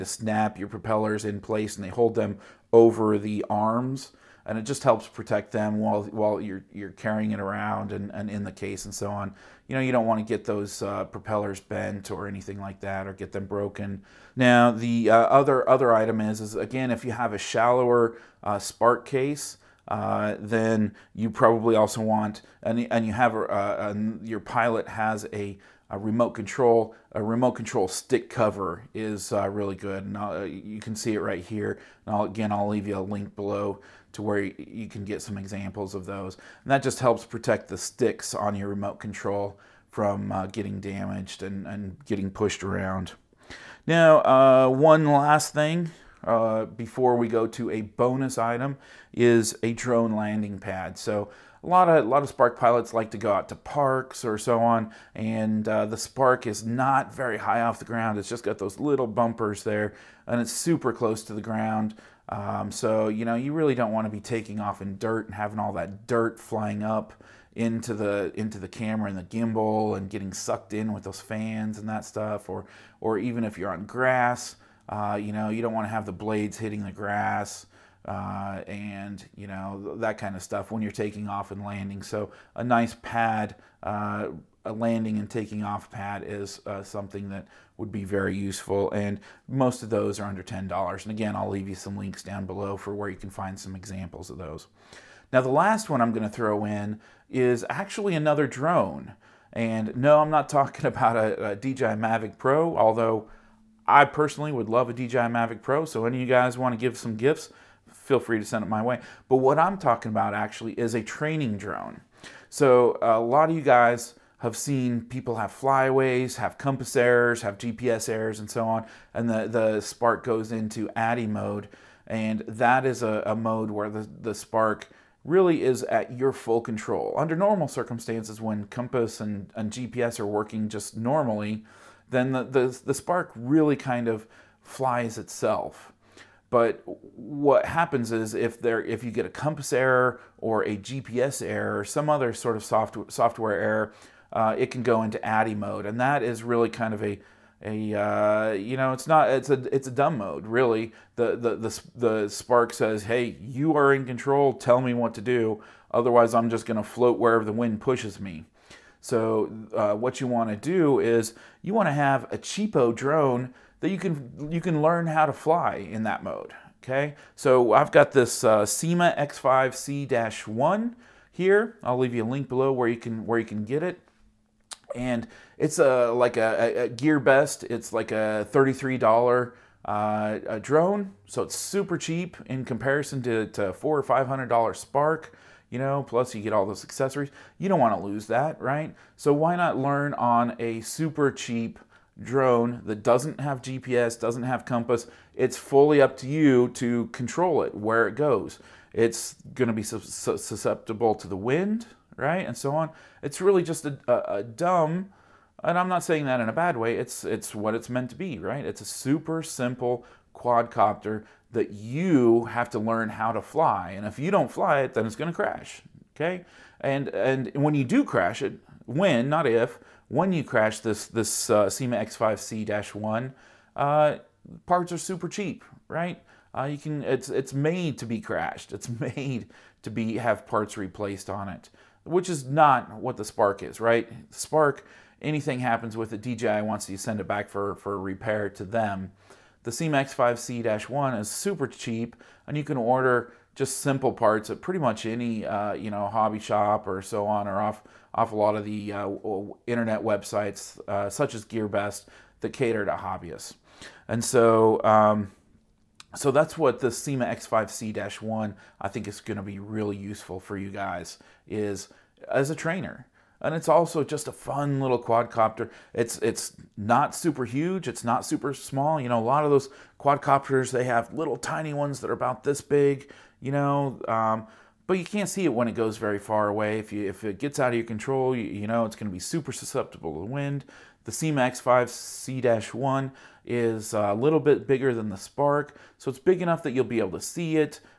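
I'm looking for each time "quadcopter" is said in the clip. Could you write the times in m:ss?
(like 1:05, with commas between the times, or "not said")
3:30, 4:25, 4:29.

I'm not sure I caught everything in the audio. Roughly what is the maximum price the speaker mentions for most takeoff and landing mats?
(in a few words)
$10.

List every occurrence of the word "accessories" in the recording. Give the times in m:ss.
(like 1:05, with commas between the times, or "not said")
3:06.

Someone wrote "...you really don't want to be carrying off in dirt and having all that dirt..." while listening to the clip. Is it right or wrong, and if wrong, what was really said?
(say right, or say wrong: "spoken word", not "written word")
wrong: "taking", not "carrying".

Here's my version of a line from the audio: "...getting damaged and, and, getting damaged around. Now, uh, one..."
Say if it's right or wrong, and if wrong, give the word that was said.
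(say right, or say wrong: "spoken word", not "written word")
wrong: "pushed", not "damaged".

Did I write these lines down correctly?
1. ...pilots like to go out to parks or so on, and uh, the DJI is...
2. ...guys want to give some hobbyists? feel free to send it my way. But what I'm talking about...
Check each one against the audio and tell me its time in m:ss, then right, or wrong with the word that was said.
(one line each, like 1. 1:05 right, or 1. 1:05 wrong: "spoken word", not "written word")
1. 0:52 wrong: "Spark", not "DJI"
2. 1:46 wrong: "gifts", not "hobbyists".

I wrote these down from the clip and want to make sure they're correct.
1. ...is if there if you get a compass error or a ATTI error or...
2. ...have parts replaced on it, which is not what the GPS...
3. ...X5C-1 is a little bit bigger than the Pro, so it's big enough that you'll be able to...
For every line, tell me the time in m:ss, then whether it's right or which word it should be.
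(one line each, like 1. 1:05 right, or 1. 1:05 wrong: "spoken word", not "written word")
1. 2:18 wrong: "GPS", not "ATTI"
2. 3:50 wrong: "Spark", not "GPS"
3. 4:41 wrong: "Spark", not "Pro".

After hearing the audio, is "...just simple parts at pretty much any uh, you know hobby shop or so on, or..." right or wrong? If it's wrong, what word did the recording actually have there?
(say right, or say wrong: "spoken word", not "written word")
right.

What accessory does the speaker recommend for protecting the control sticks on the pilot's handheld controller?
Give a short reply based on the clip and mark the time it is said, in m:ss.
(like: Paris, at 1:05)
Remote control stick cover, at 0:27.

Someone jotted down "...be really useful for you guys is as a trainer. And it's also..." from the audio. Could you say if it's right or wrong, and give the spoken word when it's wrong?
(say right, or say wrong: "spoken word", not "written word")
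right.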